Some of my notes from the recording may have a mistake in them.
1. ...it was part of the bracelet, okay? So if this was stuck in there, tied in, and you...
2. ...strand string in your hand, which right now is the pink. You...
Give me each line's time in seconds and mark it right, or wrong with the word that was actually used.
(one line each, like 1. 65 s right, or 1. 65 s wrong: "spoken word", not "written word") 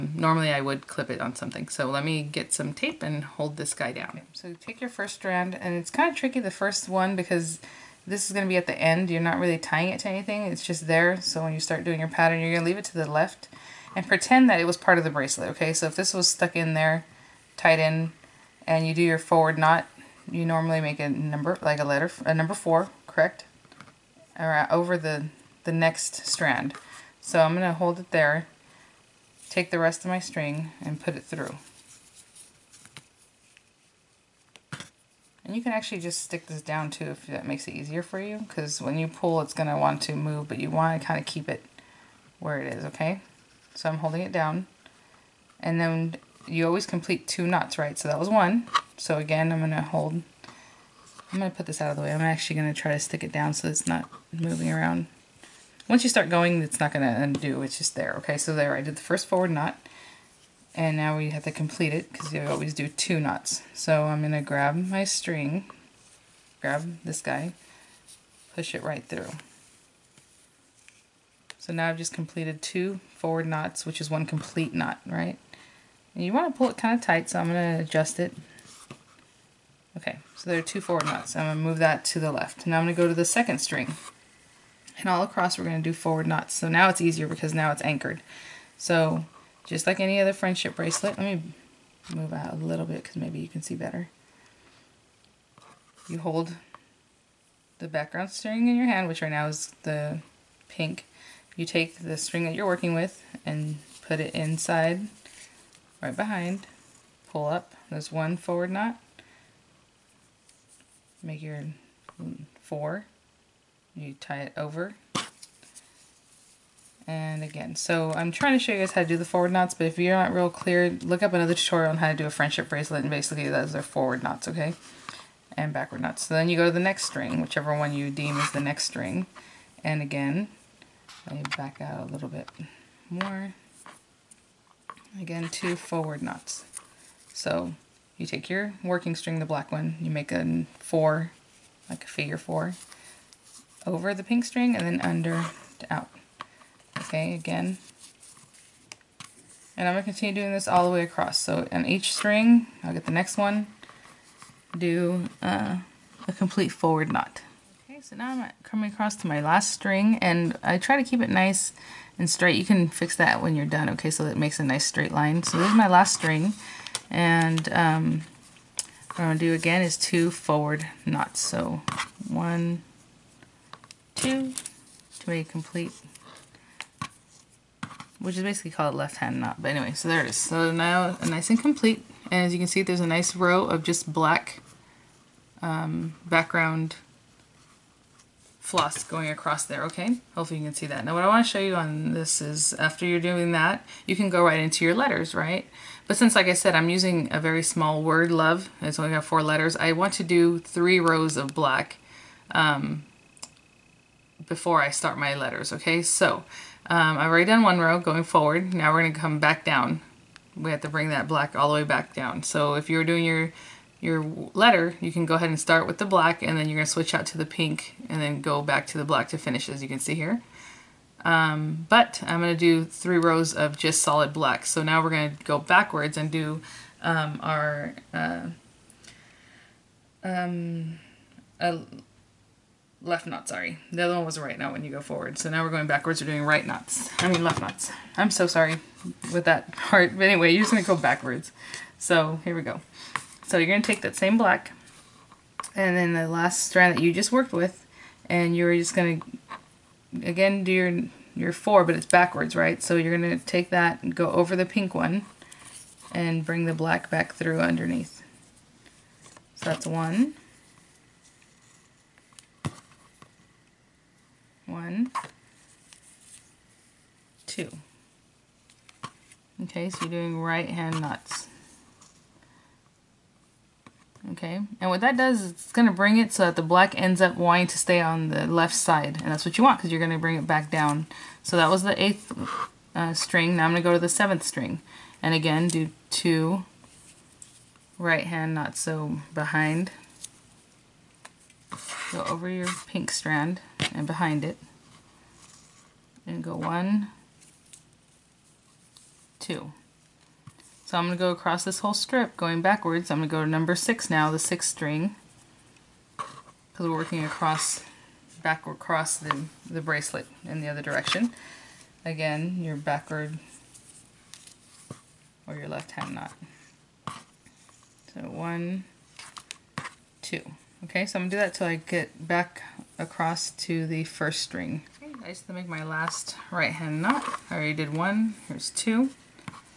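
1. 14 s right
2. 97 s wrong: "background", not "strand".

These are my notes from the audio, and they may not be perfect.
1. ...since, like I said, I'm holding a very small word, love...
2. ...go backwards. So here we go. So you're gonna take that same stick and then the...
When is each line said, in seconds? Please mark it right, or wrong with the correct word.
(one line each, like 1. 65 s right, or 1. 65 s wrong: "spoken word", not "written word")
1. 196 s wrong: "using", not "holding"
2. 240 s wrong: "black", not "stick".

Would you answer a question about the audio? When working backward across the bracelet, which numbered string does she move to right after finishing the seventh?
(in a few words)
sixth.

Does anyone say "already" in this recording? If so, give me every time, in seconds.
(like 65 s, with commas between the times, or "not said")
207 s, 327 s.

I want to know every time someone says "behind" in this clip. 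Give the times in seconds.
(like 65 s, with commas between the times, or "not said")
106 s, 289 s, 294 s.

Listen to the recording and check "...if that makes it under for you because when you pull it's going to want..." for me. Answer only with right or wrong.
wrong.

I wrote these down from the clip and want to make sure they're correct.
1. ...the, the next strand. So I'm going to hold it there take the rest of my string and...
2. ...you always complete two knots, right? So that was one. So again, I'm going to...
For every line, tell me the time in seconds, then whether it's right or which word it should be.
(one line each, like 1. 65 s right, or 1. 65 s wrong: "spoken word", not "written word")
1. 24 s right
2. 46 s right.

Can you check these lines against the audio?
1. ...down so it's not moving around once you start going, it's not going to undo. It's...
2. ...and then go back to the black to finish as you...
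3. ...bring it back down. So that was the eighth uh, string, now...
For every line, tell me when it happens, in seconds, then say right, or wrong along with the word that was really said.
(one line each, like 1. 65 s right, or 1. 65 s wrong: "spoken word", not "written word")
1. 53 s right
2. 218 s right
3. 280 s right.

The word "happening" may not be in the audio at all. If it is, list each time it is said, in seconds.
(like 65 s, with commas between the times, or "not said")
not said.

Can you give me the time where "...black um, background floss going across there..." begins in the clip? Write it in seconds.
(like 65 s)
184 s.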